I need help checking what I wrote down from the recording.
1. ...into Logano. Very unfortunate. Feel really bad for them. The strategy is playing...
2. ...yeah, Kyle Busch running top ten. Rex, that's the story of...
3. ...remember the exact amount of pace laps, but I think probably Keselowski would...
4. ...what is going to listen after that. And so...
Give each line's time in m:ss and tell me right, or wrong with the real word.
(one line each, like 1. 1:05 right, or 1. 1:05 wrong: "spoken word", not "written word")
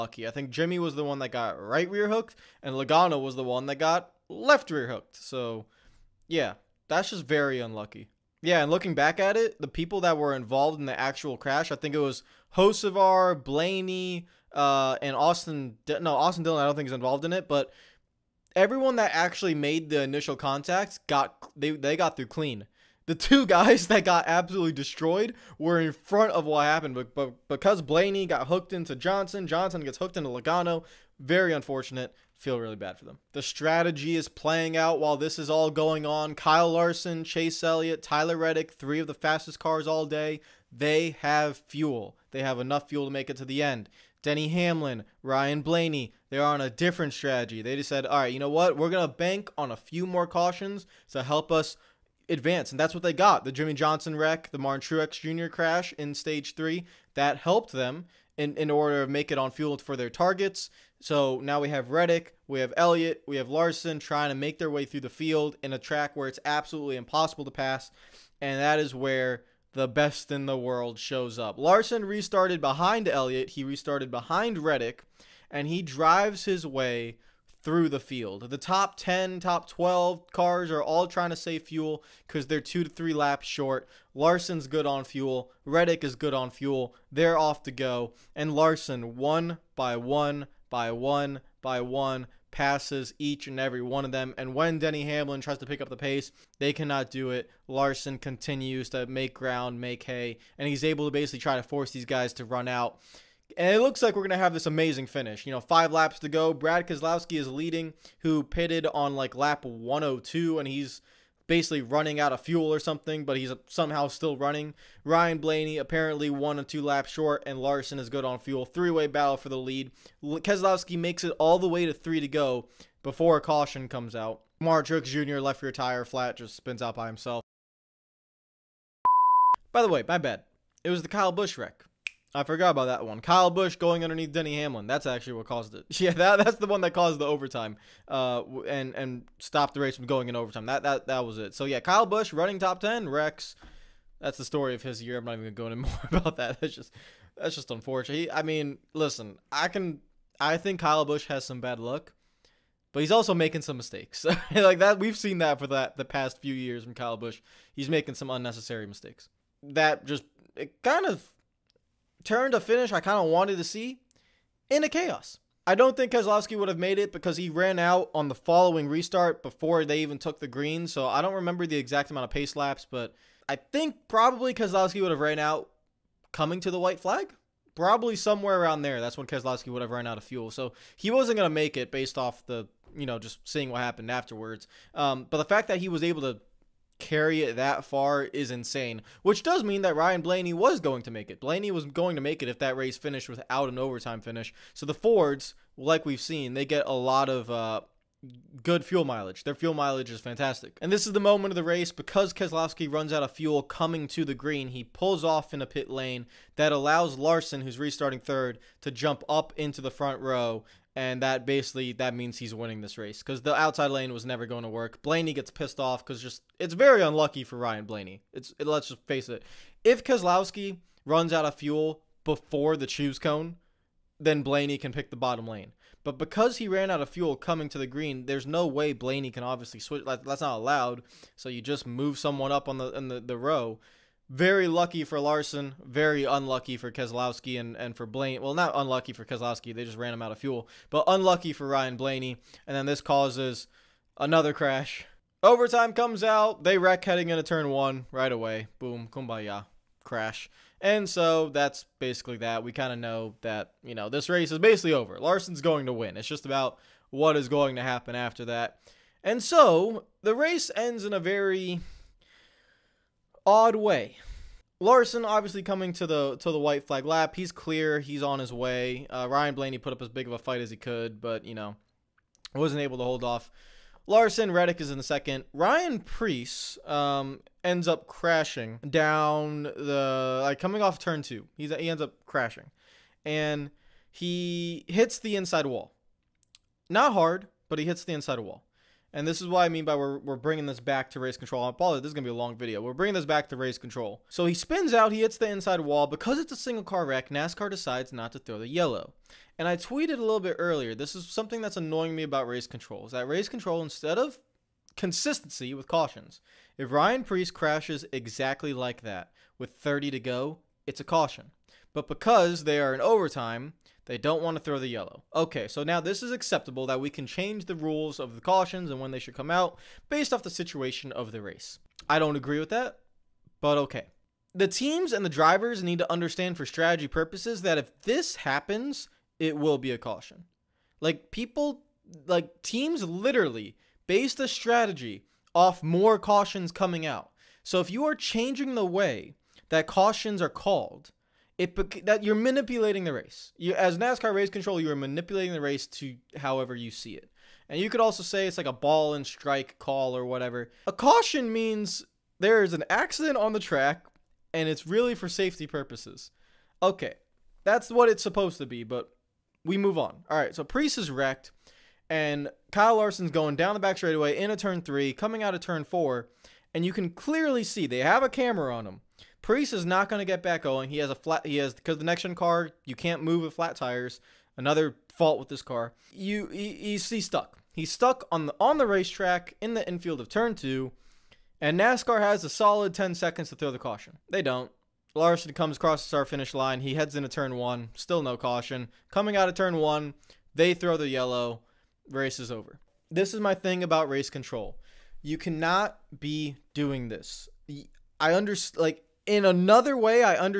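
1. 0:30 right
2. 2:21 right
3. 2:51 right
4. 4:17 wrong: "happen", not "listen".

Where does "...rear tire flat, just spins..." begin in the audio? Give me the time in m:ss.
2:05.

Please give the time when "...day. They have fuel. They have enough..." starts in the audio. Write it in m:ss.
0:40.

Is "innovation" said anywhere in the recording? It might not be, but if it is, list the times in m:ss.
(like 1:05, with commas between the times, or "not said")
not said.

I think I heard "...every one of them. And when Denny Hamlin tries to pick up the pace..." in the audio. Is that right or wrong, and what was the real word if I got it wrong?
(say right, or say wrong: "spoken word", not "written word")
right.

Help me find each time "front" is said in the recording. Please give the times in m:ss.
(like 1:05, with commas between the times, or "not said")
0:25, 3:29.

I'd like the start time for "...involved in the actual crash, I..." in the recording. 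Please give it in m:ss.
0:10.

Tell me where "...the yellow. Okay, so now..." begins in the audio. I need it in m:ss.
5:14.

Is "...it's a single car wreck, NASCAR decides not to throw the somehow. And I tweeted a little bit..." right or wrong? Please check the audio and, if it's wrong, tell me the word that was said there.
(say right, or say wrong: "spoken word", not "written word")
wrong: "yellow", not "somehow".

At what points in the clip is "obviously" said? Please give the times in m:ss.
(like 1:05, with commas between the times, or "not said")
3:49, 4:25.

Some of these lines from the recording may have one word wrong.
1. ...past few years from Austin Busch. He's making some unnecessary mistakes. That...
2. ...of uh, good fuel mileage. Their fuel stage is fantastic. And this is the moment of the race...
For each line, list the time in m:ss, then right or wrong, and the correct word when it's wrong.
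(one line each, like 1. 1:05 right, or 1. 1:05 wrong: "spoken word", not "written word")
1. 2:36 wrong: "Kyle", not "Austin"
2. 3:17 wrong: "mileage", not "stage".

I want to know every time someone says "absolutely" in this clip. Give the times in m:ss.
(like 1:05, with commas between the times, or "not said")
0:24, 1:06.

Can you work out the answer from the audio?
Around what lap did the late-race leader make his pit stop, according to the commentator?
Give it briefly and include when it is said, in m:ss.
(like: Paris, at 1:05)
102, at 1:49.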